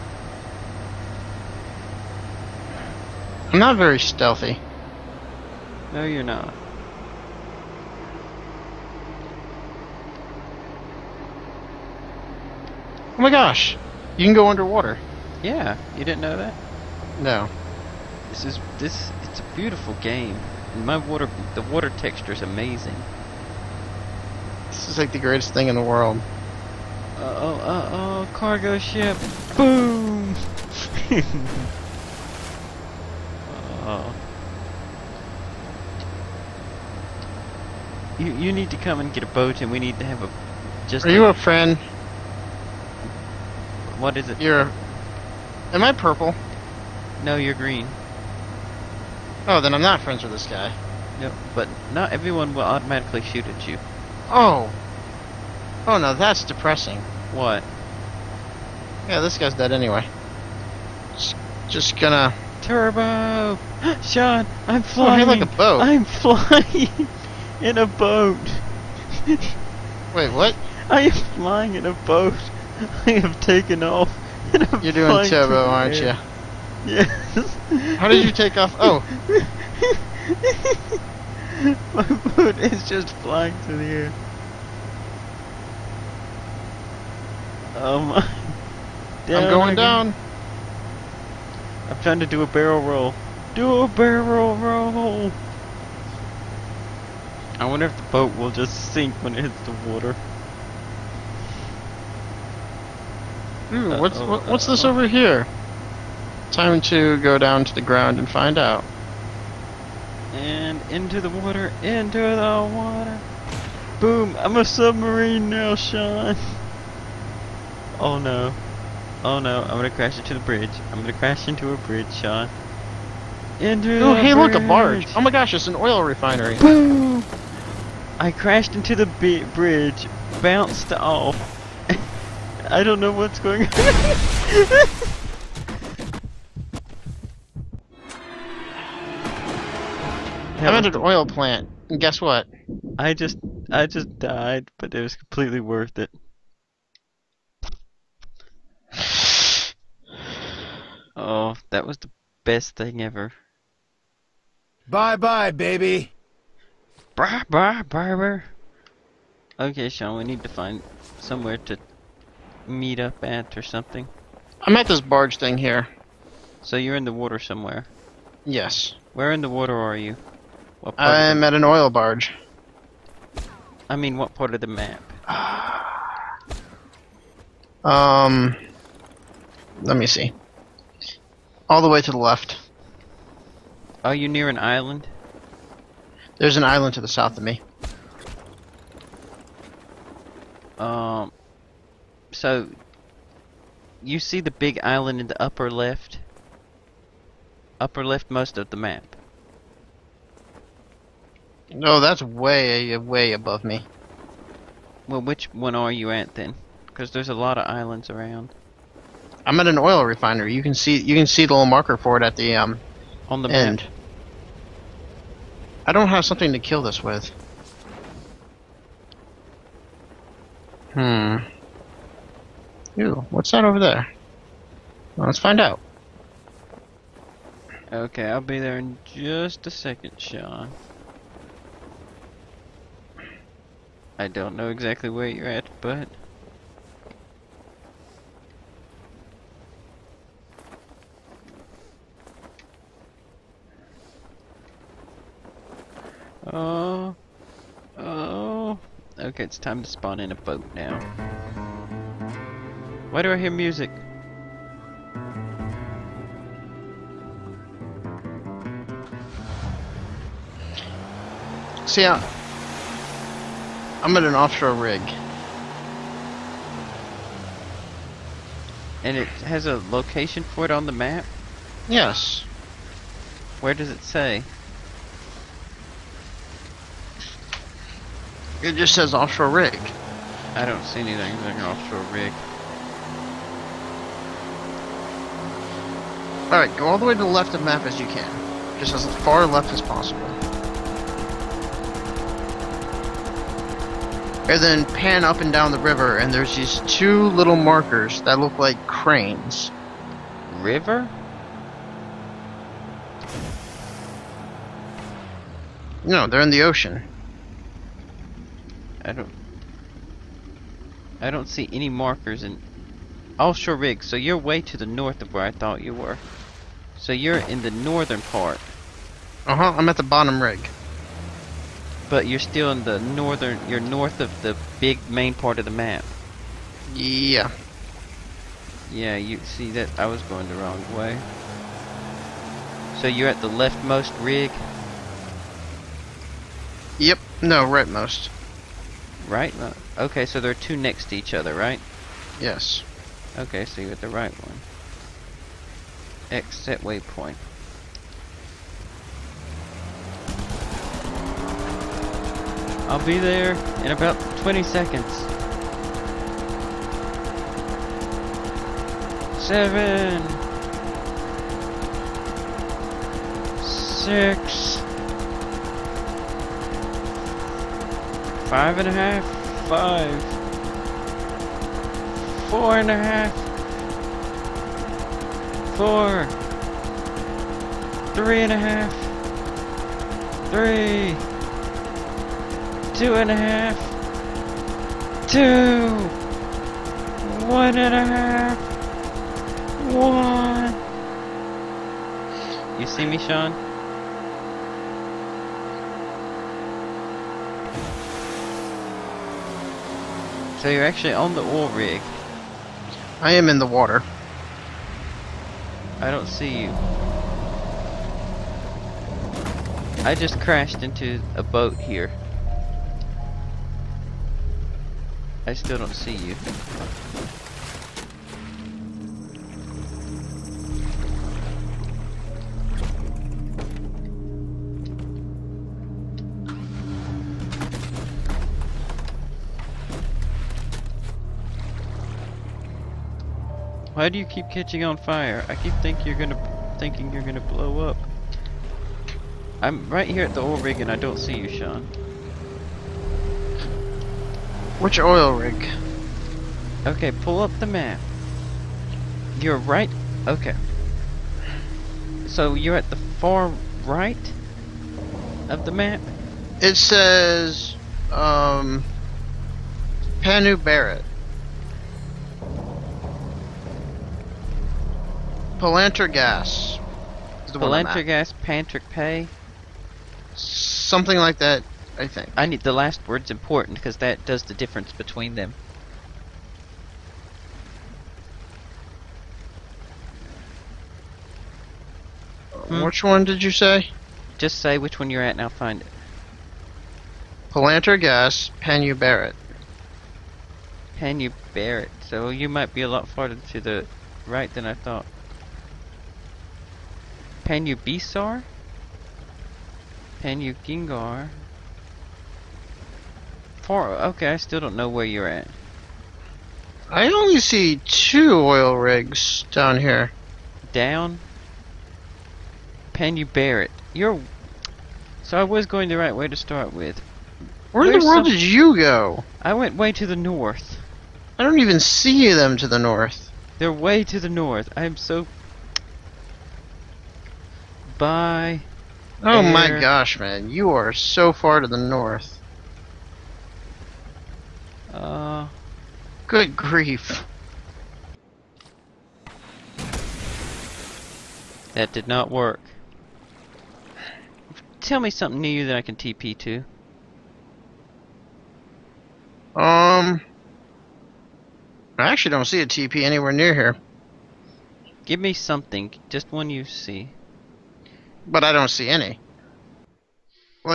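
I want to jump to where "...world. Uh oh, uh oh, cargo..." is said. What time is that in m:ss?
0:25.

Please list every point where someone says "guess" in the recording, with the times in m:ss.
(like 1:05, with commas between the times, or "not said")
2:22.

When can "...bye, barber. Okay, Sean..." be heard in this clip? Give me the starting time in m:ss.
2:37.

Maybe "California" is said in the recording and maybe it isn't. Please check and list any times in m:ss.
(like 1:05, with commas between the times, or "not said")
not said.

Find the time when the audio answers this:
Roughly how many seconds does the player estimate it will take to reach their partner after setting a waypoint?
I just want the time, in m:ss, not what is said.
5:54.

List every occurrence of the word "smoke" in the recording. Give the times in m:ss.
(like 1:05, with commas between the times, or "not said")
not said.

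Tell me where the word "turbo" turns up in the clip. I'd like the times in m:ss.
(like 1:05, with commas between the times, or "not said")
1:02, 1:15.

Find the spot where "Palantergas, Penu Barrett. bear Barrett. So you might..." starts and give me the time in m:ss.
8:07.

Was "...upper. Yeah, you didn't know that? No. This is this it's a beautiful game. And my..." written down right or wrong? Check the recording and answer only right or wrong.
wrong.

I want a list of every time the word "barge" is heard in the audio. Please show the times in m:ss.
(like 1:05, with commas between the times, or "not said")
2:04, 2:45, 2:51.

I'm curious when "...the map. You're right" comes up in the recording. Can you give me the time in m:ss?
7:27.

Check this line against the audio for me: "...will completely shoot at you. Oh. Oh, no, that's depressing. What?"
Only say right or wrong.
wrong.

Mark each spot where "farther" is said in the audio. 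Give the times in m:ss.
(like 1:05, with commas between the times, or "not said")
8:13.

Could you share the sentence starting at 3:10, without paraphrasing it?
Um, so, you see the big island in the upper left?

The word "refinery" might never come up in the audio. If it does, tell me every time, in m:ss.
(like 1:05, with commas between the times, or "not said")
2:06, 3:30.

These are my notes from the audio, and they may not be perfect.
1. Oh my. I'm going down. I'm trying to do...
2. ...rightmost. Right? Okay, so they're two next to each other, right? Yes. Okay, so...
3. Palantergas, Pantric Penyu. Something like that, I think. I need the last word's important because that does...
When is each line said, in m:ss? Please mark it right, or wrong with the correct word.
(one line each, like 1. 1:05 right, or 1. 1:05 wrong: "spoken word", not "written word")
1. 1:27 right
2. 5:37 right
3. 7:47 wrong: "Pay", not "Penyu".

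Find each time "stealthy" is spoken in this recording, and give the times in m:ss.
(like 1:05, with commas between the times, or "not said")
0:03.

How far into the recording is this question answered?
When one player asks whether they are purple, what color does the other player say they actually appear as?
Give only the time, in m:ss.
0:47.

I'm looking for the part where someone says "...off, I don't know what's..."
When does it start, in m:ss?
2:10.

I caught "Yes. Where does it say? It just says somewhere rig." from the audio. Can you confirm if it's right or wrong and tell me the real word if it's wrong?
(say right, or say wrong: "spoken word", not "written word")
wrong: "offshore", not "somewhere".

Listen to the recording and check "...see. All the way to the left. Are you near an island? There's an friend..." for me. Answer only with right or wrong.
wrong.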